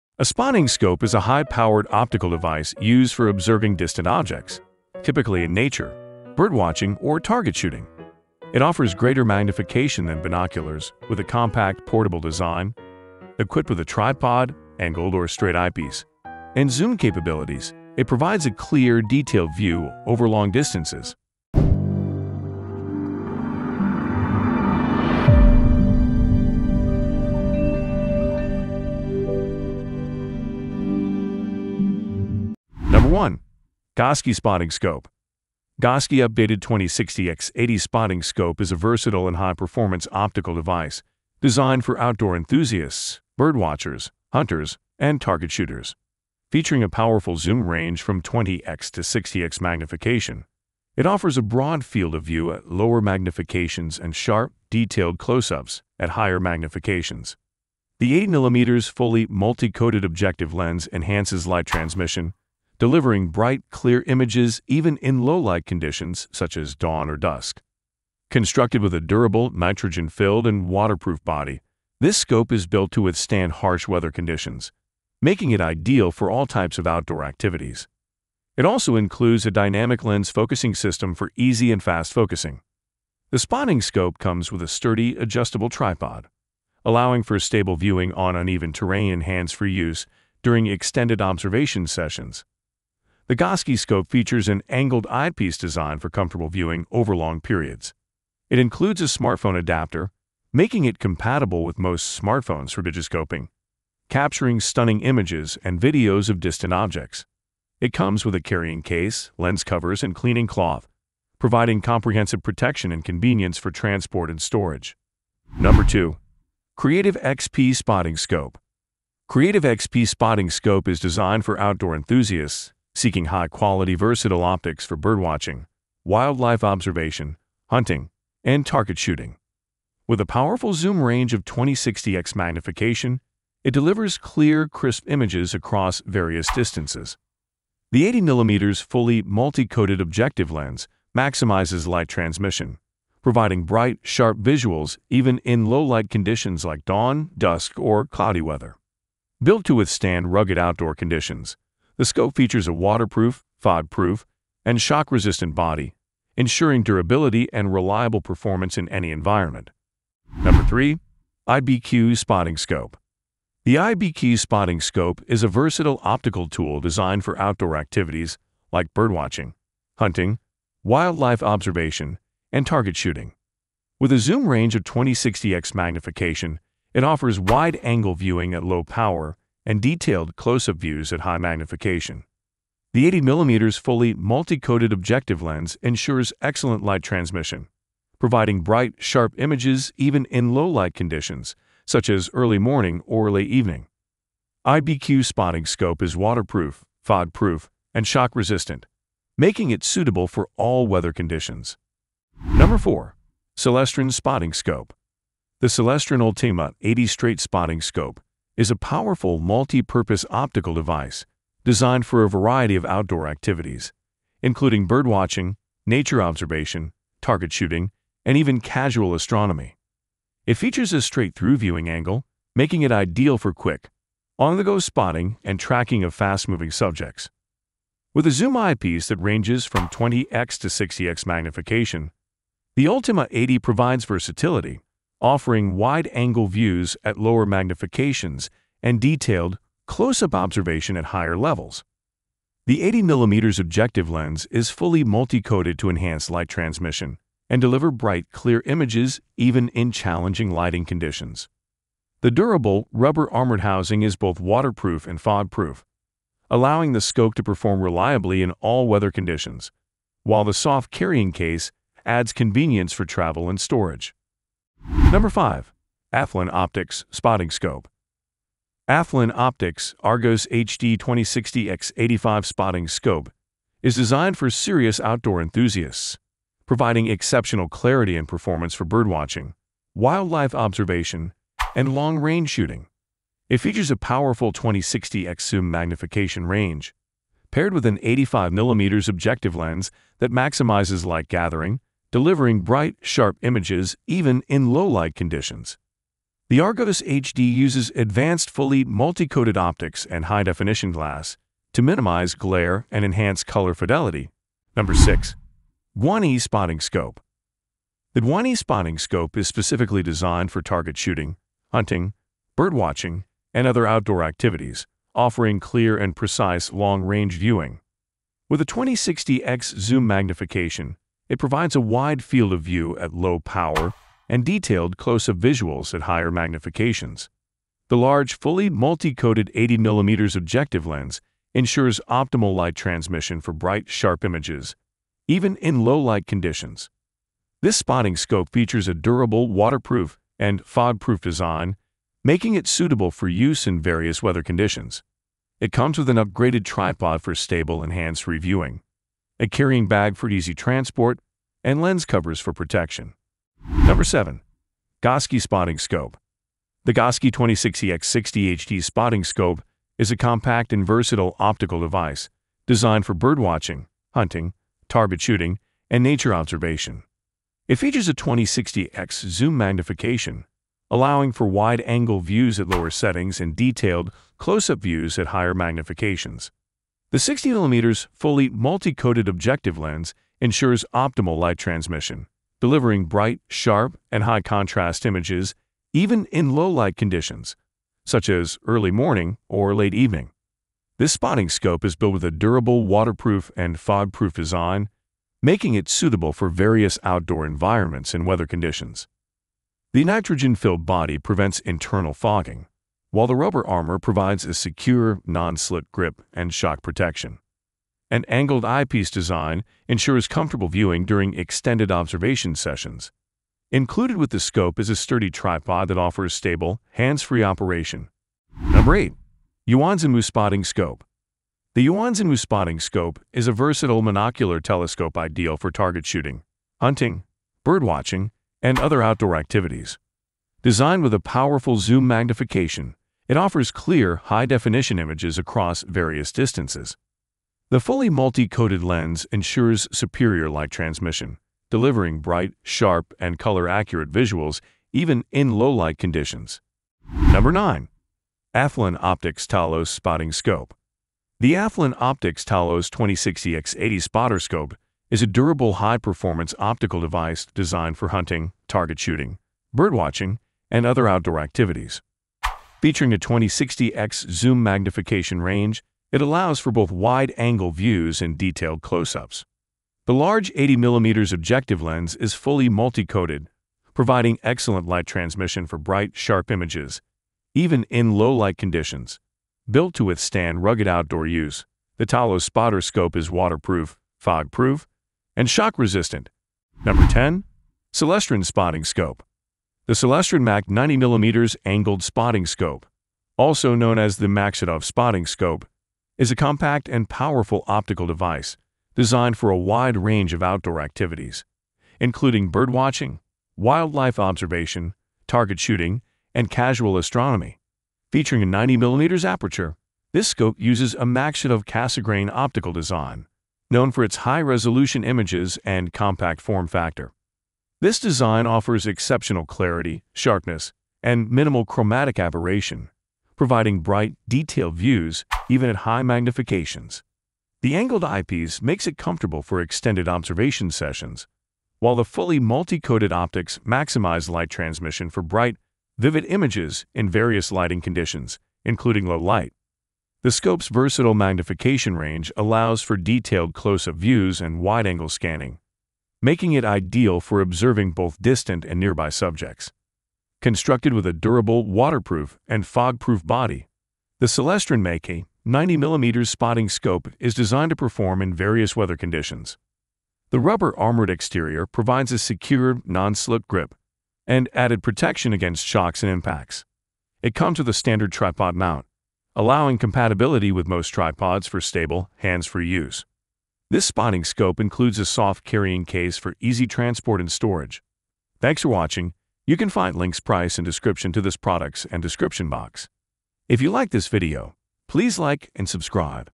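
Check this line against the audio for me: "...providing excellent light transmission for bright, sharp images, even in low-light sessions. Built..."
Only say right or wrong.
wrong.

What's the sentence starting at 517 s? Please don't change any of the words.
This design offers exceptional clarity, sharpness, and minimal chromatic aberration, providing bright, detailed views even at high magnifications.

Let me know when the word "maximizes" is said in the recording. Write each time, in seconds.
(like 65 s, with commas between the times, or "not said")
141 s, 290 s, 533 s.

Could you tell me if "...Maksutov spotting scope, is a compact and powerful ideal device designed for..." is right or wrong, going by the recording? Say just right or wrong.
wrong.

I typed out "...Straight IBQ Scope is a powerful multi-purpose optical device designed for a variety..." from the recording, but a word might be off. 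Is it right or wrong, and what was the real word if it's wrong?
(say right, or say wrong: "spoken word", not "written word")
wrong: "Spotting", not "IBQ".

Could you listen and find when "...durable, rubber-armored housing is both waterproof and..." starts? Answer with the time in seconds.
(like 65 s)
252 s.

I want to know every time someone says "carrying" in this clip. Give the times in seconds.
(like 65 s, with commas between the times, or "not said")
108 s, 260 s, 349 s, 575 s.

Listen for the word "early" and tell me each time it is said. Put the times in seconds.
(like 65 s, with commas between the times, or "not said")
192 s, 388 s.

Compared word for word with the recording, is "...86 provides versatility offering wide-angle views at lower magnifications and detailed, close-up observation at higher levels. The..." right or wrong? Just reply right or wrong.
wrong.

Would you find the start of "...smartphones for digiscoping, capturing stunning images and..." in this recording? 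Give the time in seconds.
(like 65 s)
102 s.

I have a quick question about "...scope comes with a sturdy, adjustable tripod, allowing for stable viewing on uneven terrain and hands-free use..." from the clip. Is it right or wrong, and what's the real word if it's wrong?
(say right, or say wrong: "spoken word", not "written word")
right.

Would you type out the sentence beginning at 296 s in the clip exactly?
The Argos HD uses advanced fully multi-coated optics and high-definition glass to minimize glare and enhance color fidelity.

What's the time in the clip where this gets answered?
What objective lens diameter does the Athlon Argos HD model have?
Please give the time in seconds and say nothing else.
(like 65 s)
287 s.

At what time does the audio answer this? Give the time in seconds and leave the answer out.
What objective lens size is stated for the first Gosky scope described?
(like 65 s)
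58 s.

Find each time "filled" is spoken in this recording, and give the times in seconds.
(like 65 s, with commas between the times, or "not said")
69 s, 400 s.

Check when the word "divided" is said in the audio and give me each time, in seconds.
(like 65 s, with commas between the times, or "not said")
not said.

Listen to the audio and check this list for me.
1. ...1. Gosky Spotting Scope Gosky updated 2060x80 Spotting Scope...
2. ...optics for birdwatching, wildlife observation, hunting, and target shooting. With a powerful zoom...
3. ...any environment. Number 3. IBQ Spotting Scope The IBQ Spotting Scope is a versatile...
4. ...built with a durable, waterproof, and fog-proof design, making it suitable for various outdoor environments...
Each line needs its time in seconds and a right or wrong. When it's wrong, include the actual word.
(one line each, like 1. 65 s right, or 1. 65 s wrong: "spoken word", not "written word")
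1. 33 s right
2. 124 s right
3. 158 s right
4. 391 s right.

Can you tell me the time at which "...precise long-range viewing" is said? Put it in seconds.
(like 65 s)
316 s.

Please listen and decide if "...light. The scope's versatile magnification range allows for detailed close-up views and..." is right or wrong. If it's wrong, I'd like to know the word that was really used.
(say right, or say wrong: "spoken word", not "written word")
right.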